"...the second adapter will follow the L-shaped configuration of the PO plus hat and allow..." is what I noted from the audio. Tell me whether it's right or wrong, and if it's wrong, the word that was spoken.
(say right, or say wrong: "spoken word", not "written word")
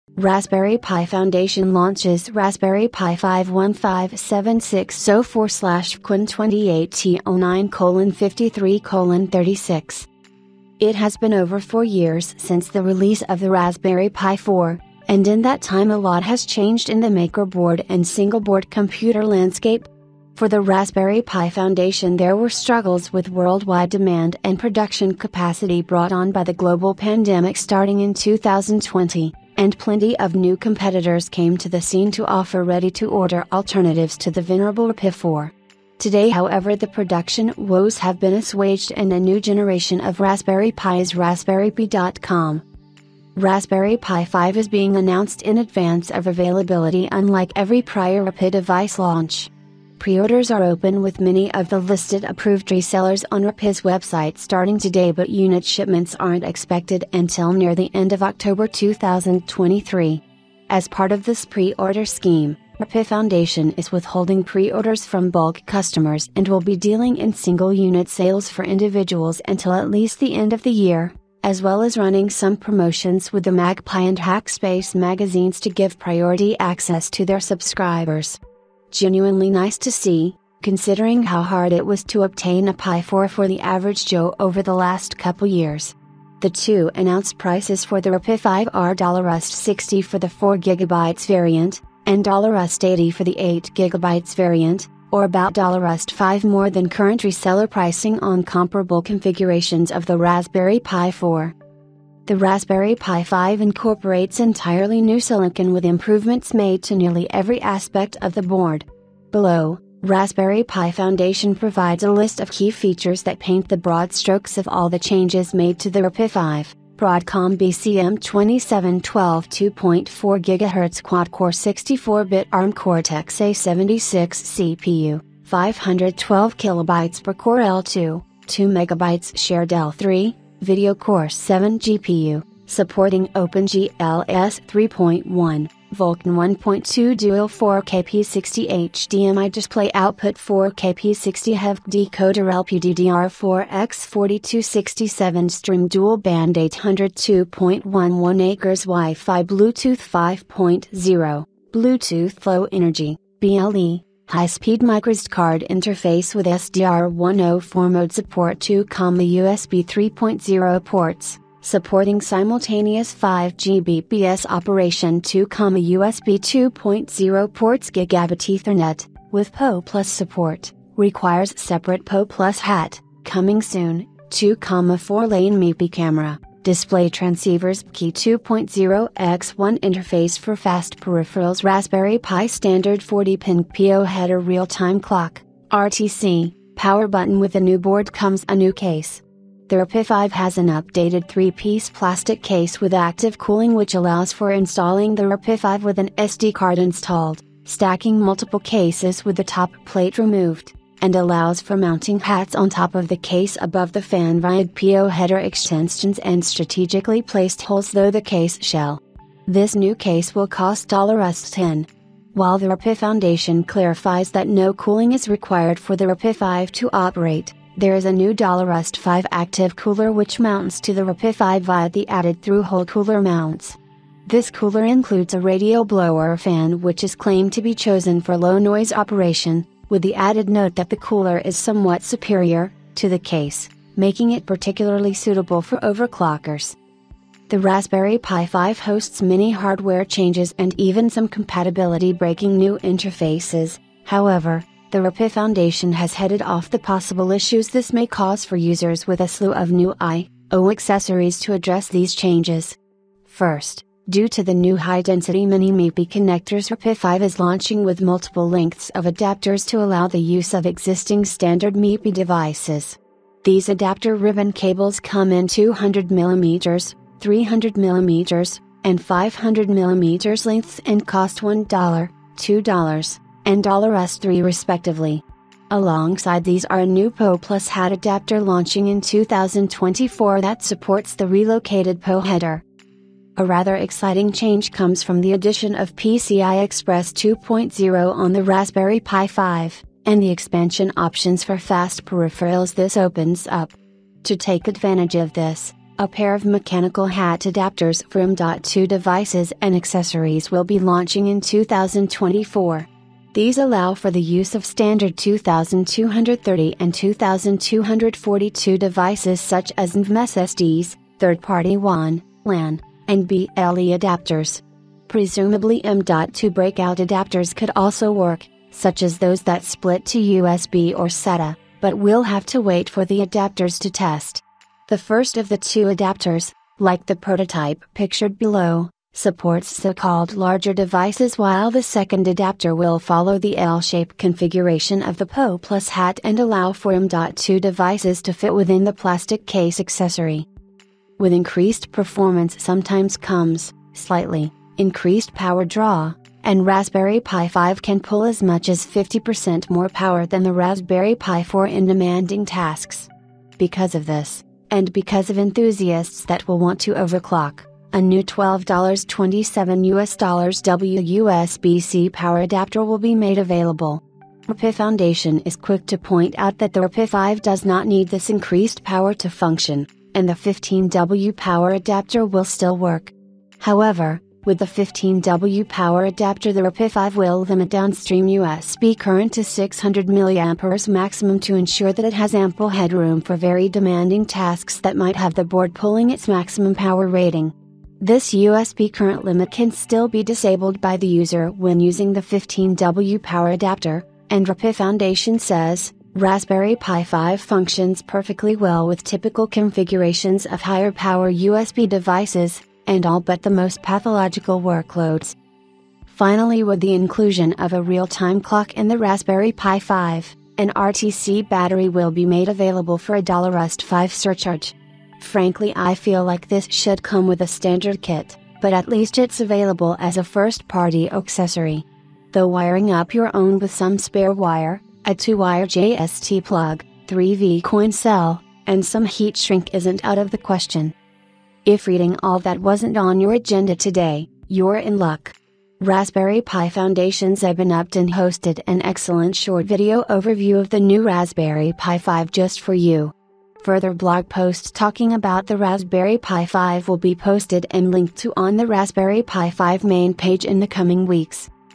right.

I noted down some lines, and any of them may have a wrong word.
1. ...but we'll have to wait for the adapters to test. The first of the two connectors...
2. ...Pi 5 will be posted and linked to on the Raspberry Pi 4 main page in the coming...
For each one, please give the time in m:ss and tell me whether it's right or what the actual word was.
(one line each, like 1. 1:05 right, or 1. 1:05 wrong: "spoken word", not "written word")
1. 5:21 wrong: "adapters", not "connectors"
2. 7:26 wrong: "5", not "4".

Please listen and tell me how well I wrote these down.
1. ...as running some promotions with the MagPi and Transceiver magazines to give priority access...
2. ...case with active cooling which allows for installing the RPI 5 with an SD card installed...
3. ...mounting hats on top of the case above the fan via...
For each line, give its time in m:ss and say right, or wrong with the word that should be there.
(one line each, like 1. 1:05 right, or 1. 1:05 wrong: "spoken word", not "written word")
1. 1:11 wrong: "Hackspace", not "Transceiver"
2. 3:12 right
3. 3:21 right.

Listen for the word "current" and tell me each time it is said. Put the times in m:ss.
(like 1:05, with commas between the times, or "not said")
1:36, 6:18, 6:28.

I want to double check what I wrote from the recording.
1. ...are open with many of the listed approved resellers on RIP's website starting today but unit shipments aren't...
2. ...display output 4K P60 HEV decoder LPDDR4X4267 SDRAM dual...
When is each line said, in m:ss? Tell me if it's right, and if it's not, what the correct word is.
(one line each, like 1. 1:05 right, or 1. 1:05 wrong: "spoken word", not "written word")
1. 0:50 right
2. 2:19 right.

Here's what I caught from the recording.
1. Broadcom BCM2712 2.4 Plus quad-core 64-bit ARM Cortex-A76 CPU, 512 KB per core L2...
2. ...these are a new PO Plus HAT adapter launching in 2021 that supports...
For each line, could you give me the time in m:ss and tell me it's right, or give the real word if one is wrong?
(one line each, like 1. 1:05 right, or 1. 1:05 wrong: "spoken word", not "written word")
1. 1:56 wrong: "GHz", not "Plus"
2. 4:36 wrong: "2024", not "2021".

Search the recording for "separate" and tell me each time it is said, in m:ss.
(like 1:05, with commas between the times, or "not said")
2:51.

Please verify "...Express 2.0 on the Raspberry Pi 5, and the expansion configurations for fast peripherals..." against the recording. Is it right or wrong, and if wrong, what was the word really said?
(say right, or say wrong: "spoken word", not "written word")
wrong: "options", not "configurations".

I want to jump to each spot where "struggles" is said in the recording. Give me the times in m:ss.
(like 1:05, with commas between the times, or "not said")
0:22.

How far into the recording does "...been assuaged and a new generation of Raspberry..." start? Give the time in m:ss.
0:38.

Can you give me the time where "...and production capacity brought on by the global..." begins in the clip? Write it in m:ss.
0:24.